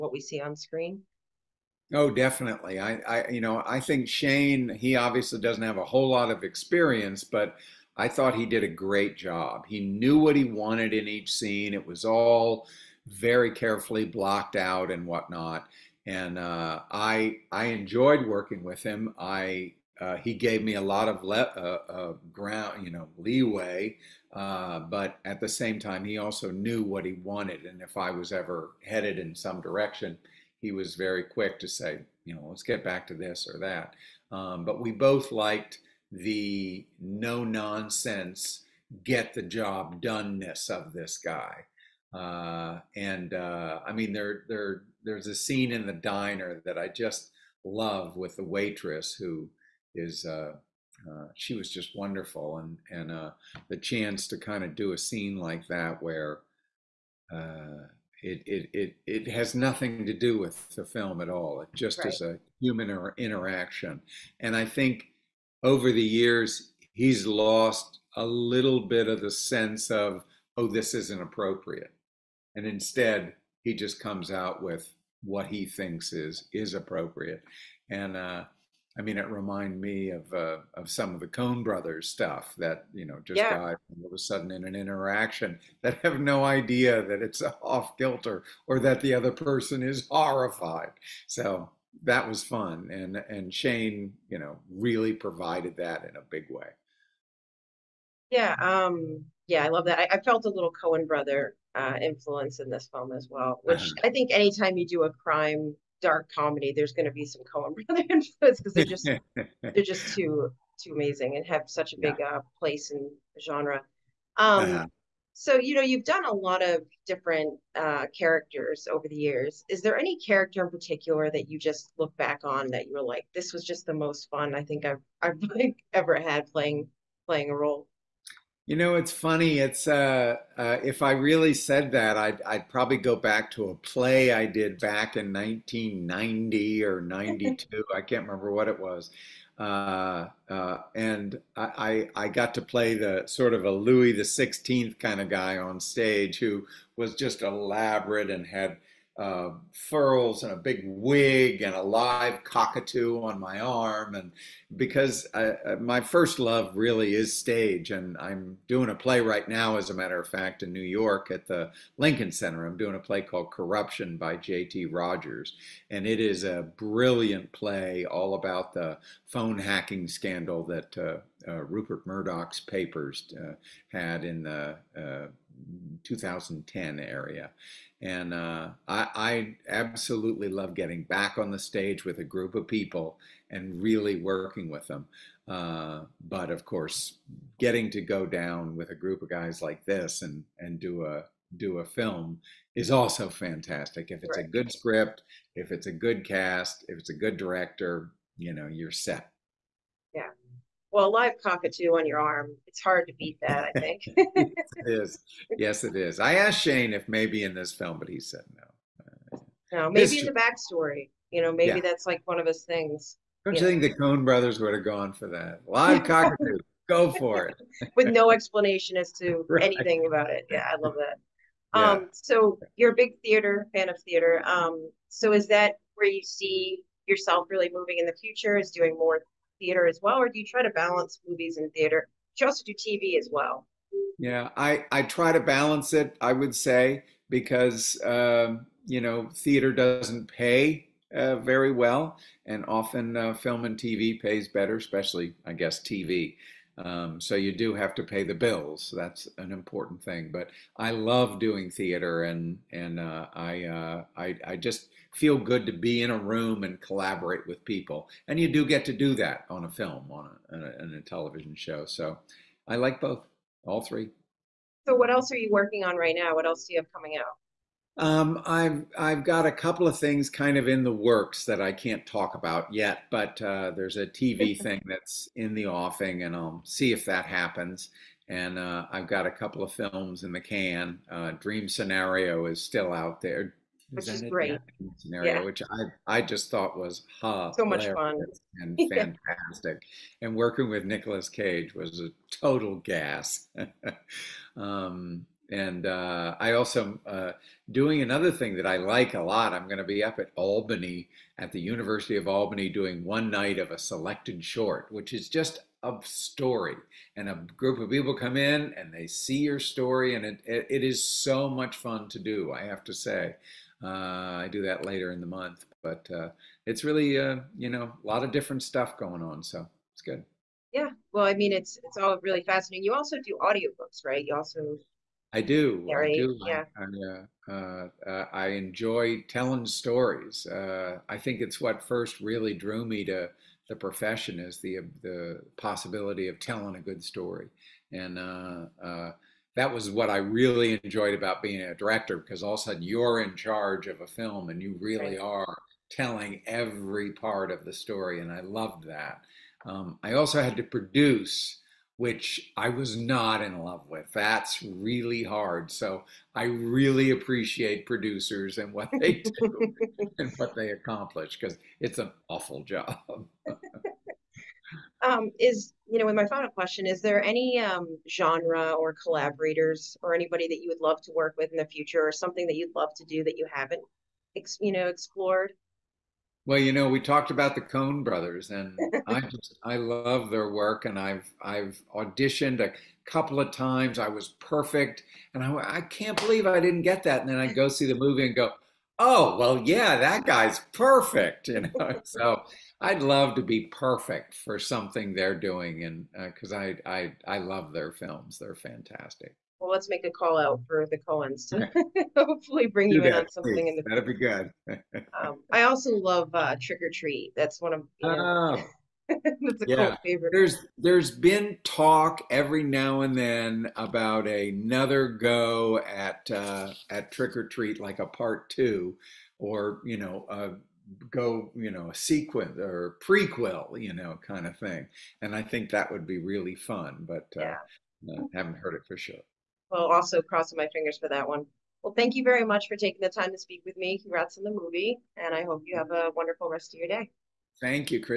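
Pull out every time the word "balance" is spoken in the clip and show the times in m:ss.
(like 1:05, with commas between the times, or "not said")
3:50, 3:55.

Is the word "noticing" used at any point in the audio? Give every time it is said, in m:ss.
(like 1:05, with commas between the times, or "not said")
not said.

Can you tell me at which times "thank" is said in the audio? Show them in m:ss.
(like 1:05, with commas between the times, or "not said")
7:11, 7:17.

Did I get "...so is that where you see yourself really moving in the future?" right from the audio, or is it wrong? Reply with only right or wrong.
right.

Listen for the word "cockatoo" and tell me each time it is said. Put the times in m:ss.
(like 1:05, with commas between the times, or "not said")
2:32, 3:21, 3:36.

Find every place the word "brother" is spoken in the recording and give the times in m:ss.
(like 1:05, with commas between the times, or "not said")
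1:21, 1:41, 1:47, 3:34, 6:18.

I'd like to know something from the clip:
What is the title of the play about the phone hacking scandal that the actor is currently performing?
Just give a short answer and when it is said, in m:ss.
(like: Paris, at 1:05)
Corruption, at 2:43.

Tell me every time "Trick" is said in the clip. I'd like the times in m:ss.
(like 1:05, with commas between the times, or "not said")
6:46, 6:57.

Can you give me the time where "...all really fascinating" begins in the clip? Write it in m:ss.
5:21.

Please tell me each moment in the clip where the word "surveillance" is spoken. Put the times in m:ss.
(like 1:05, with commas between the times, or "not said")
not said.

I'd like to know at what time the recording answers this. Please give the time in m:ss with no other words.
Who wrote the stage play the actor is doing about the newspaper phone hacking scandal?
2:44.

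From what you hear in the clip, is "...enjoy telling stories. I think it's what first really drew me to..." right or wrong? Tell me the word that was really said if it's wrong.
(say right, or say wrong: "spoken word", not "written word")
right.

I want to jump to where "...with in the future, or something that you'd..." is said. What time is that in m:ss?
6:11.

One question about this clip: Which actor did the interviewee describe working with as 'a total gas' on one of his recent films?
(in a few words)
Nicolas Cage.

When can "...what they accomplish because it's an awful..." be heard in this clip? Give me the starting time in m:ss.
6:00.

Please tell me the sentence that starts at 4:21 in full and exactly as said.
So I like both, all three.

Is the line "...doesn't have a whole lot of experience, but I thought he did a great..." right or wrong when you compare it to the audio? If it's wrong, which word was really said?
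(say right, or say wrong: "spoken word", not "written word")
right.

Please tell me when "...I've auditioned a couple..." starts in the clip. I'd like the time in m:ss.
6:21.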